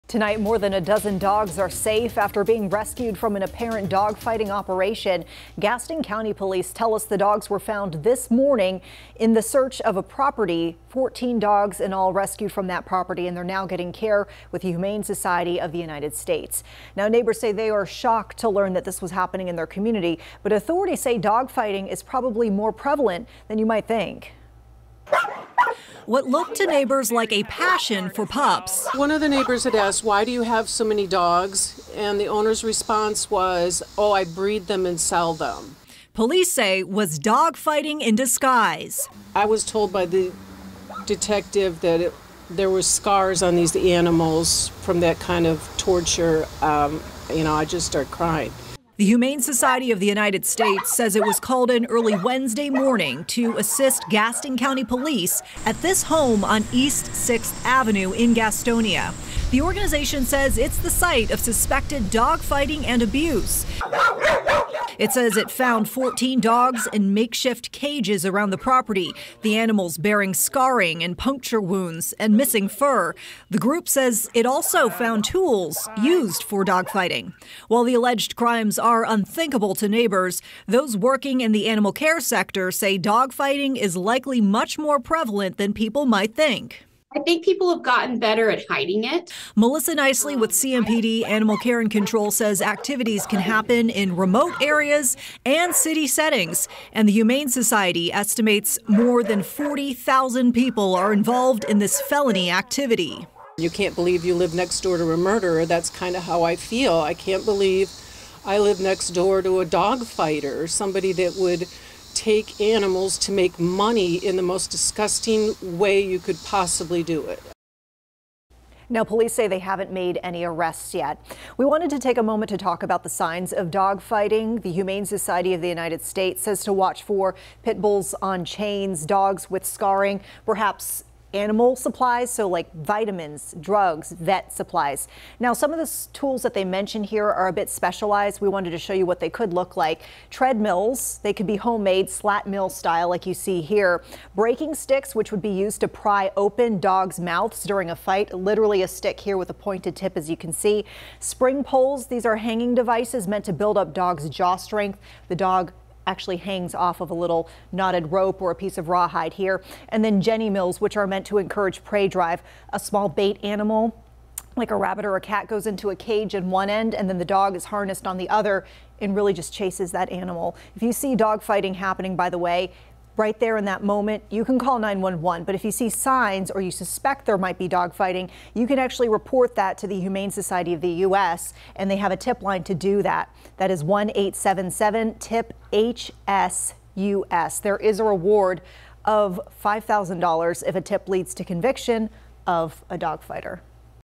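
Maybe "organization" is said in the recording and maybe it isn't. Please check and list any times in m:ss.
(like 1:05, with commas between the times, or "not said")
0:59.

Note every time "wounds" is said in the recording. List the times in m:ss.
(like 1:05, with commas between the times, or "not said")
1:11.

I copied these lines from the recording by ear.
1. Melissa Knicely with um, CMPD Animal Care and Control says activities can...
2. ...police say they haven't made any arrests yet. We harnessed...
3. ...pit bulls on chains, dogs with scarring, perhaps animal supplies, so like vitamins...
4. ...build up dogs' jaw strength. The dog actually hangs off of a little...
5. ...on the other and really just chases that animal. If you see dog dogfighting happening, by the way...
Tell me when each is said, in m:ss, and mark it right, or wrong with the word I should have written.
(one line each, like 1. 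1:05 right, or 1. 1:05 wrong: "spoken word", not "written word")
1. 1:29 right
2. 1:59 wrong: "wanted", not "harnessed"
3. 2:07 right
4. 2:33 right
5. 2:48 wrong: "fighting", not "dogfighting".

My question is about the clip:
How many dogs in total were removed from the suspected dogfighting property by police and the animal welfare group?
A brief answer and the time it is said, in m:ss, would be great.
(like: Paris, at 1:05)
14, at 0:10.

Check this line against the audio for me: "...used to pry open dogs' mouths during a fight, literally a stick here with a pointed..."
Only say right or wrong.
right.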